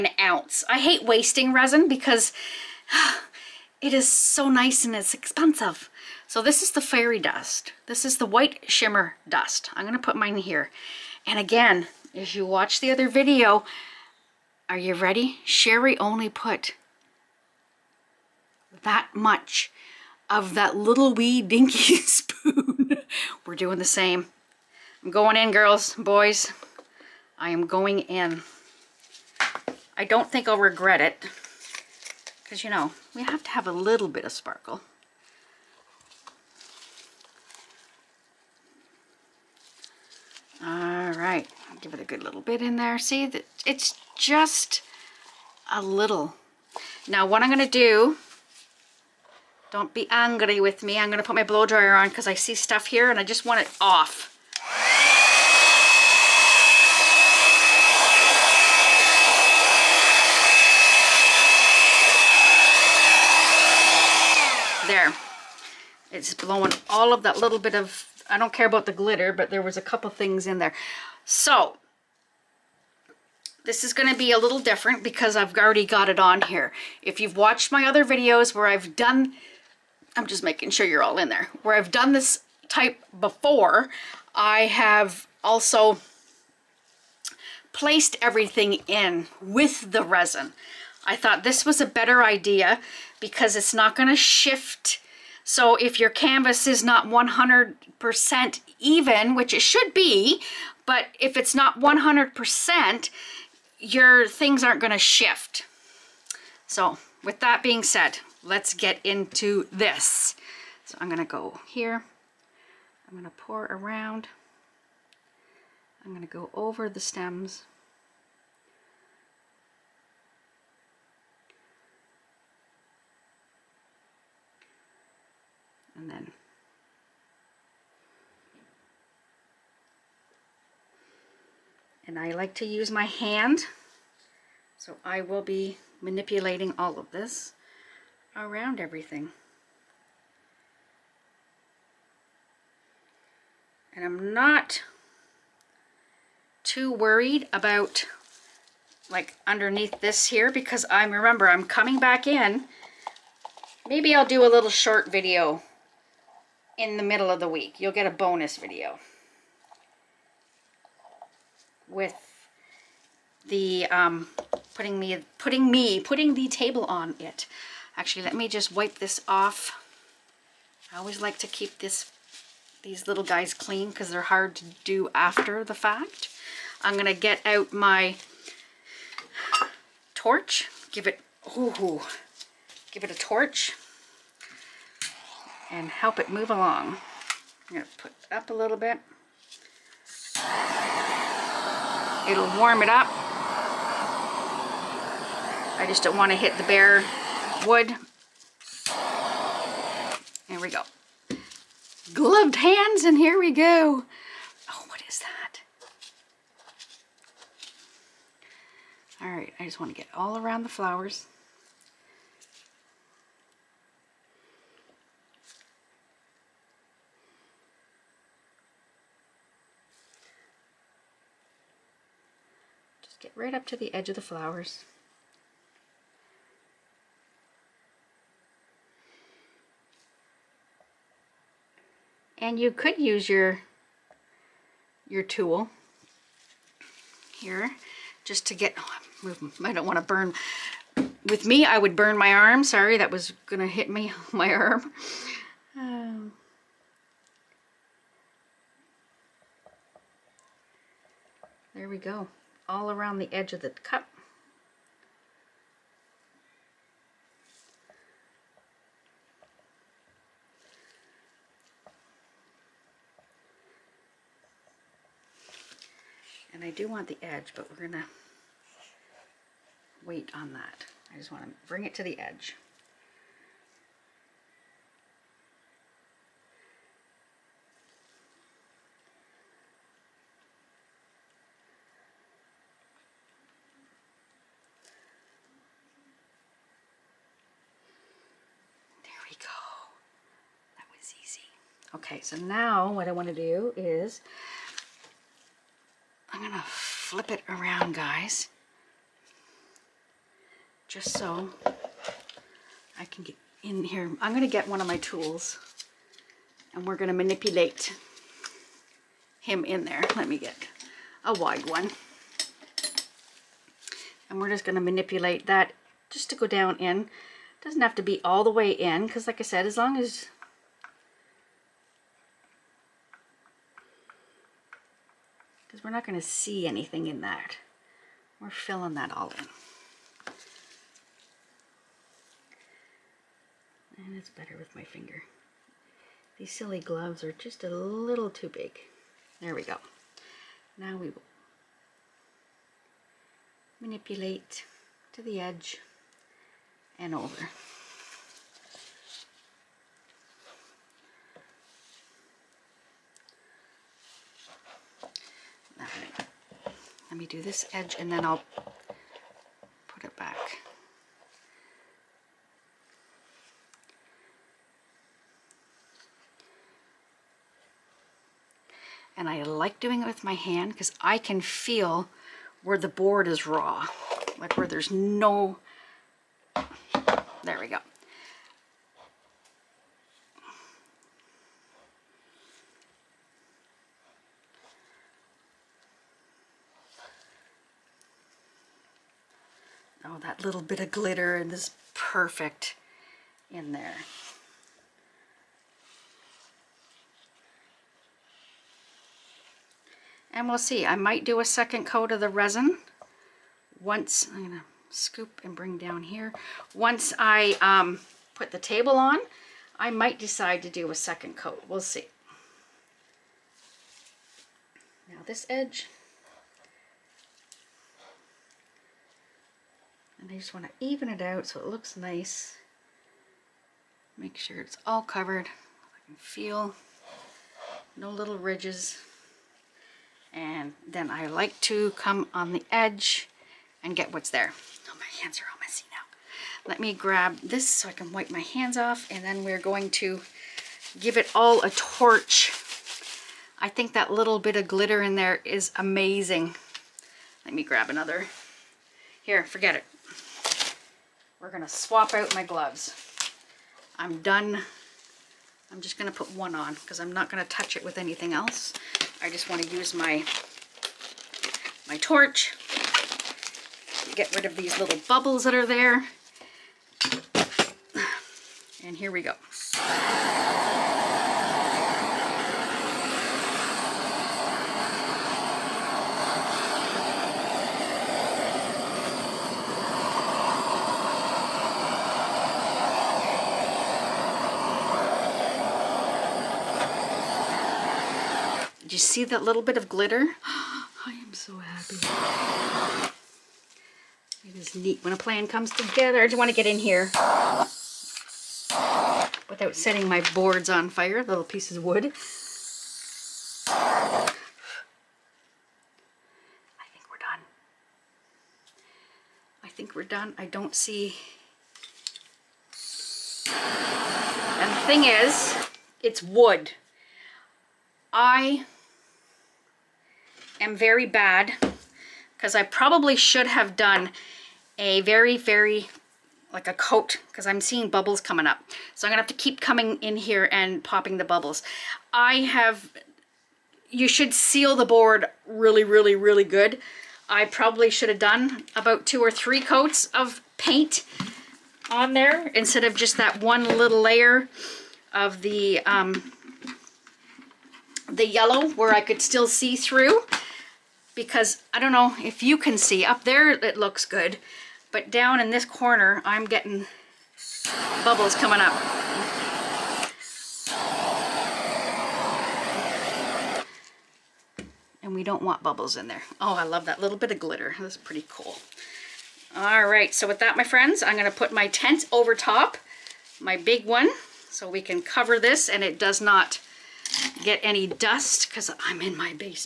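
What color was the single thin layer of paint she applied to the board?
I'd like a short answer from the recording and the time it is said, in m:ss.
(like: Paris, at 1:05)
yellow, at 9:08.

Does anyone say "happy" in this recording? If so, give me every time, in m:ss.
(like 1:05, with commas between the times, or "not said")
8:11.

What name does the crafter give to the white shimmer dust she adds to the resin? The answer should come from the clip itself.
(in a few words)
fairy dust.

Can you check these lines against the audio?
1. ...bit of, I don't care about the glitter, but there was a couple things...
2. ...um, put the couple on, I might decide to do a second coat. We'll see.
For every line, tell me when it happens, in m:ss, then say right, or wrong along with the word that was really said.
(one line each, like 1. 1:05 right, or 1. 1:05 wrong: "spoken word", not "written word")
1. 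1:07 right
2. 6:47 wrong: "table", not "couple".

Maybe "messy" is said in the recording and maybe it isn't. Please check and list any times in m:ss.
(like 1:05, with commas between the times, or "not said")
7:15.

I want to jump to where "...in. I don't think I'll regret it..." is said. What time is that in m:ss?
0:28.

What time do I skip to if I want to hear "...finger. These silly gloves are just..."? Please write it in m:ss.
5:34.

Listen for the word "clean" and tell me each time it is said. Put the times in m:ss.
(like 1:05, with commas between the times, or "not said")
2:53.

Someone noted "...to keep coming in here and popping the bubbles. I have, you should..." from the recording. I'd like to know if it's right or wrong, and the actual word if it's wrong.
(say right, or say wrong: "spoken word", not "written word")
right.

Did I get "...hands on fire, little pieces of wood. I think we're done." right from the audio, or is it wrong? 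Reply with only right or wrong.
wrong.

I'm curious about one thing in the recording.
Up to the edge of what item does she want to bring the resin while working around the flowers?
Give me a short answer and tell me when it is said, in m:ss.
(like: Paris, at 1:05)
the cup, at 4:13.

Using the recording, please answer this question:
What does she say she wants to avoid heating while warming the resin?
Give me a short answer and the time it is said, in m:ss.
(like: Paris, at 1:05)
the bare wood, at 3:16.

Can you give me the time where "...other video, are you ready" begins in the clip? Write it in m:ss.
0:12.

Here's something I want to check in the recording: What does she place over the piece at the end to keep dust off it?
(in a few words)
tent.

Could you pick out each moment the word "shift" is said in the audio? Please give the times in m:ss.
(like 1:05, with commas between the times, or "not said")
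1:34, 1:44.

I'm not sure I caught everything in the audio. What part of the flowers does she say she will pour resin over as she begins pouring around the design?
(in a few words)
the stems.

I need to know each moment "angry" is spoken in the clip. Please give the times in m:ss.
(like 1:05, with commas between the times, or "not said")
0:50.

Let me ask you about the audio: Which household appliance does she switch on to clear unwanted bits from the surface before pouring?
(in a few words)
blow dryer.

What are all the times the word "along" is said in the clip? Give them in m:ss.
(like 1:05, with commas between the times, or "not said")
3:06.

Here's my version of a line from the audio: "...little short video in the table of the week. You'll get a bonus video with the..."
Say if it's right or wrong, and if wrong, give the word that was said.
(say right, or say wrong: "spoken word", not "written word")
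wrong: "middle", not "table".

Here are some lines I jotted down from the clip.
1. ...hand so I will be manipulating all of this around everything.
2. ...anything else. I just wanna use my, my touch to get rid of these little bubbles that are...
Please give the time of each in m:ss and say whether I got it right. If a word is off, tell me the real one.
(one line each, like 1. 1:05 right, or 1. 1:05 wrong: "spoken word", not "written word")
1. 2:13 right
2. 7:37 wrong: "torch", not "touch".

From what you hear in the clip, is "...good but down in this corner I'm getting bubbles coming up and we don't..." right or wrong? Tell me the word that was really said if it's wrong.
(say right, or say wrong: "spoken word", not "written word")
right.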